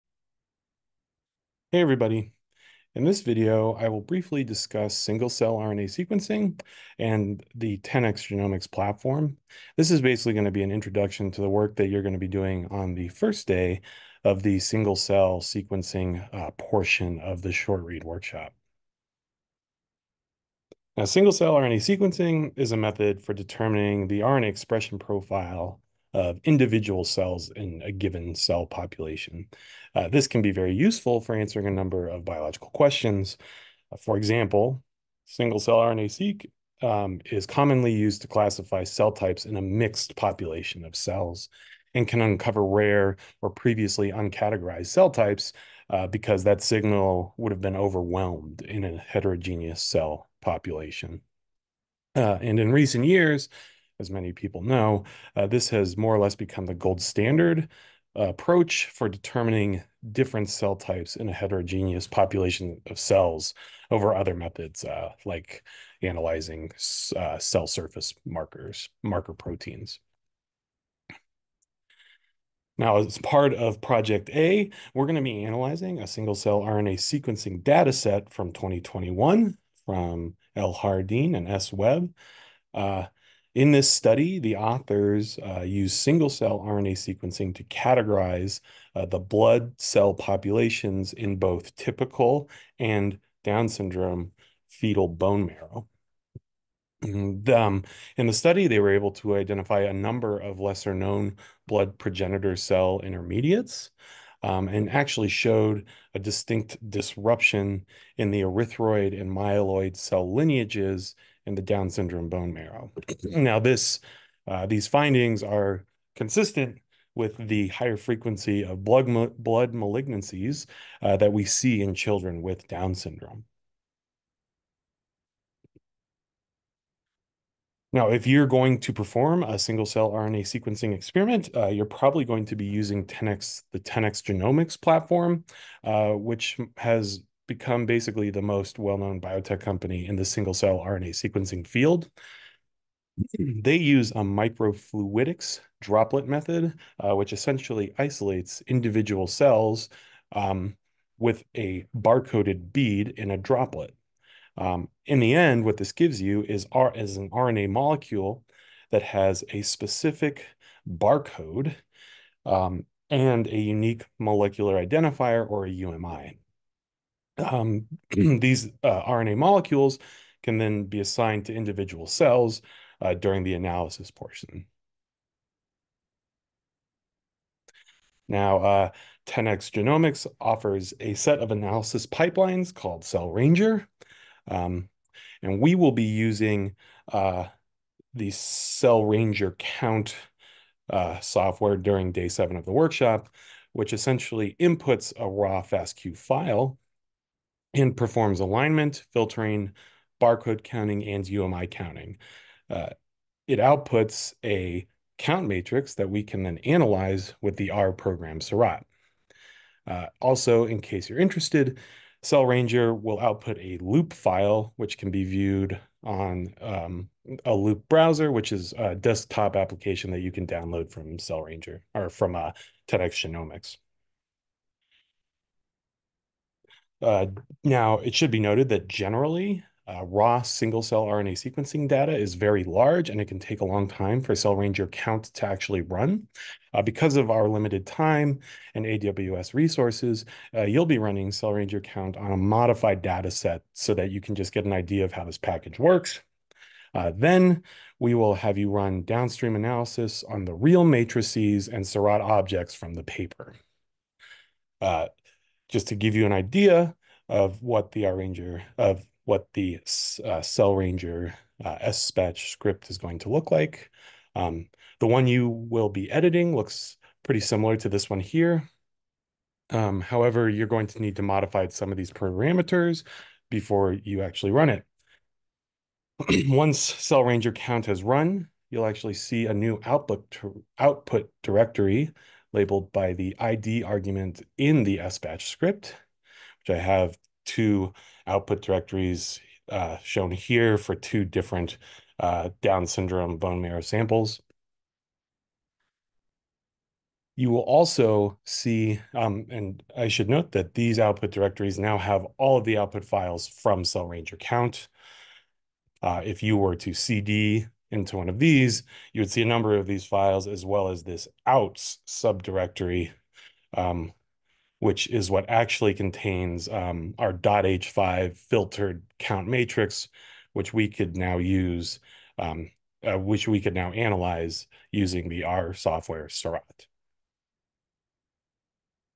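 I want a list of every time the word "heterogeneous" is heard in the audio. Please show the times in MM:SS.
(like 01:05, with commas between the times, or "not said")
00:48, 01:01.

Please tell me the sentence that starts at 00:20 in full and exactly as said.
Now, single-cell RNA sequencing is a method for determining the RNA expression profile of individual cells in a given cell population.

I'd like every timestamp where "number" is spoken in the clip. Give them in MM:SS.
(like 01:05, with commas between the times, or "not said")
00:31, 01:39, 05:09.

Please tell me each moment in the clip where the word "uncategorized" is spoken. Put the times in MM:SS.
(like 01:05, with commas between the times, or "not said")
00:44.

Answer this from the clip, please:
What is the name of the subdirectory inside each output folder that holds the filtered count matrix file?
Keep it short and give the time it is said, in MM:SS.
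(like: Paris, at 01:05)
outs, at 05:11.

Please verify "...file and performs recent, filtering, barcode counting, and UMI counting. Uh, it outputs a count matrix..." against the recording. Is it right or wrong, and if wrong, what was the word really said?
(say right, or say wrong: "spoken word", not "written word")
wrong: "alignment", not "recent".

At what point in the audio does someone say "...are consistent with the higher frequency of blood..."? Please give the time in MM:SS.
01:55.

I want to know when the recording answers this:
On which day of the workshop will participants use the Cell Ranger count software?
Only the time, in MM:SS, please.
03:12.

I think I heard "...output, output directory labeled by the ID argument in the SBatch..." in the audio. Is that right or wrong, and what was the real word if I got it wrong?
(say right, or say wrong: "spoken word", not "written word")
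right.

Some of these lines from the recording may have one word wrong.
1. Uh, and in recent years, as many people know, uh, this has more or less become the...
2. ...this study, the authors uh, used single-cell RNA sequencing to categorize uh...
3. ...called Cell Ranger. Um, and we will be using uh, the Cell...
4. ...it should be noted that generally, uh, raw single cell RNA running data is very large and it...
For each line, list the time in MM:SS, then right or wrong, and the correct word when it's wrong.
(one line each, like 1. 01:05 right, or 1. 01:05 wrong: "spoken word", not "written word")
1. 00:52 right
2. 01:23 right
3. 03:02 right
4. 03:47 wrong: "sequencing", not "running".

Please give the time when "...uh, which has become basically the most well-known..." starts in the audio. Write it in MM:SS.
02:15.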